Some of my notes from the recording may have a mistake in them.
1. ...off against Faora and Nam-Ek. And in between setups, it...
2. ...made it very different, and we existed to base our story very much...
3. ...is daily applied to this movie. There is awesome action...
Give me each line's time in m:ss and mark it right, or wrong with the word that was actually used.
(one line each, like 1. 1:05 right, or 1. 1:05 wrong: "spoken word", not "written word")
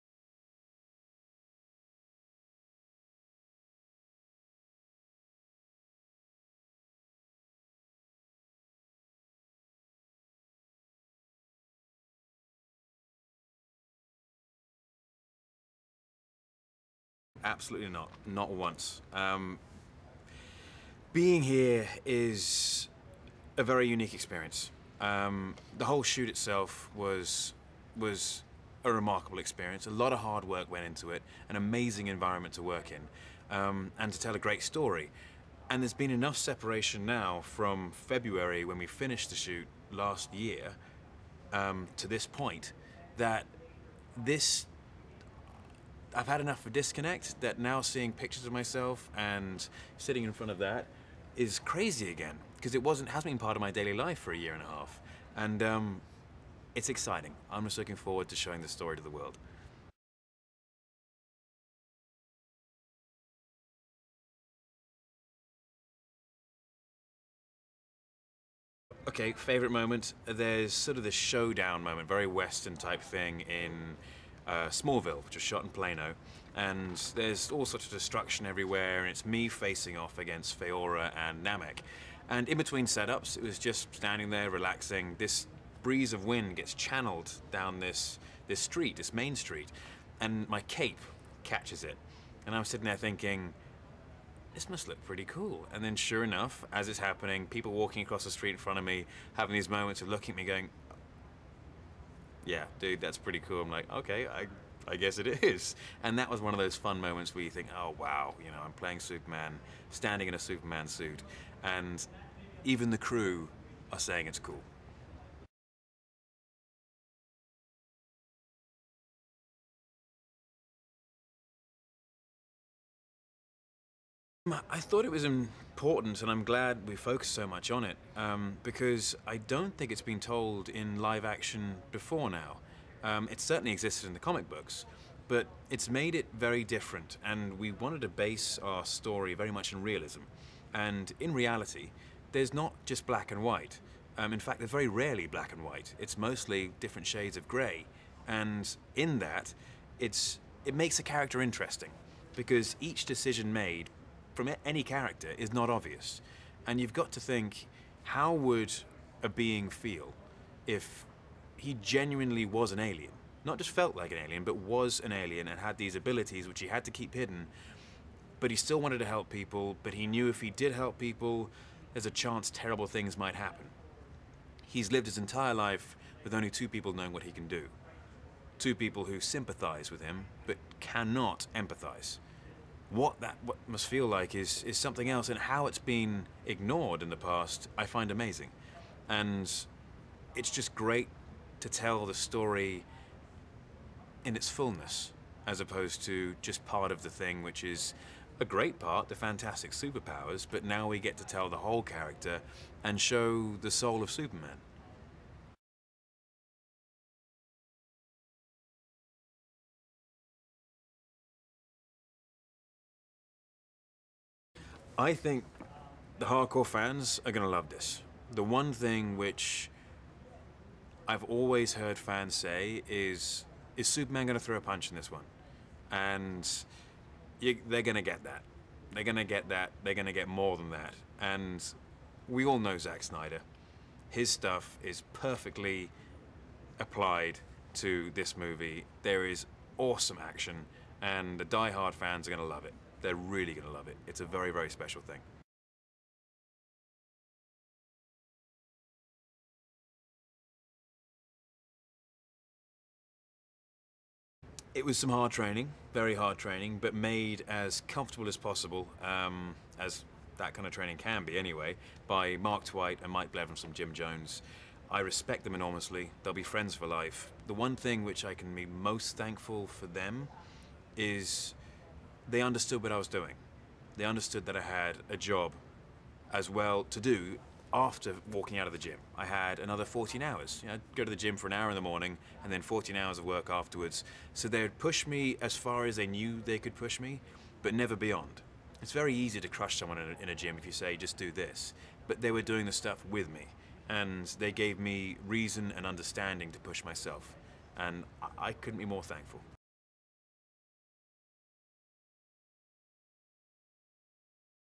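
1. 1:19 right
2. 2:15 wrong: "wanted", not "existed"
3. 3:54 wrong: "perfectly", not "daily".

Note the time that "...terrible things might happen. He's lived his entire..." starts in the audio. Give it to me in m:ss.
2:52.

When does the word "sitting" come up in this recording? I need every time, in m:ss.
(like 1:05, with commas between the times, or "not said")
0:49, 1:32.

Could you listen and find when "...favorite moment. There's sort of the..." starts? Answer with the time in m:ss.
1:09.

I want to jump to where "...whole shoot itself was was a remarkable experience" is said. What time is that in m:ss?
0:25.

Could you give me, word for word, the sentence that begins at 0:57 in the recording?
I'm just looking forward to showing the story to the world.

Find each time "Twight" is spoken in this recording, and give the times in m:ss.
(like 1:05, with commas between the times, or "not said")
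4:22.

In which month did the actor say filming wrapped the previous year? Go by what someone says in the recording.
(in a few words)
February.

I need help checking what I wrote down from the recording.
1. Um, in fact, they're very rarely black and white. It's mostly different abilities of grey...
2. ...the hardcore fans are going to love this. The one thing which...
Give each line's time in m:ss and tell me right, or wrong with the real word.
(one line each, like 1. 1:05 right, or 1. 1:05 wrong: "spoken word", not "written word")
1. 2:24 wrong: "shades", not "abilities"
2. 3:36 right.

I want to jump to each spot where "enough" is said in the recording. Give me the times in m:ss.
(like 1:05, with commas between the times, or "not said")
0:36, 0:46, 1:36.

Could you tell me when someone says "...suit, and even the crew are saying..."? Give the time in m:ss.
1:50.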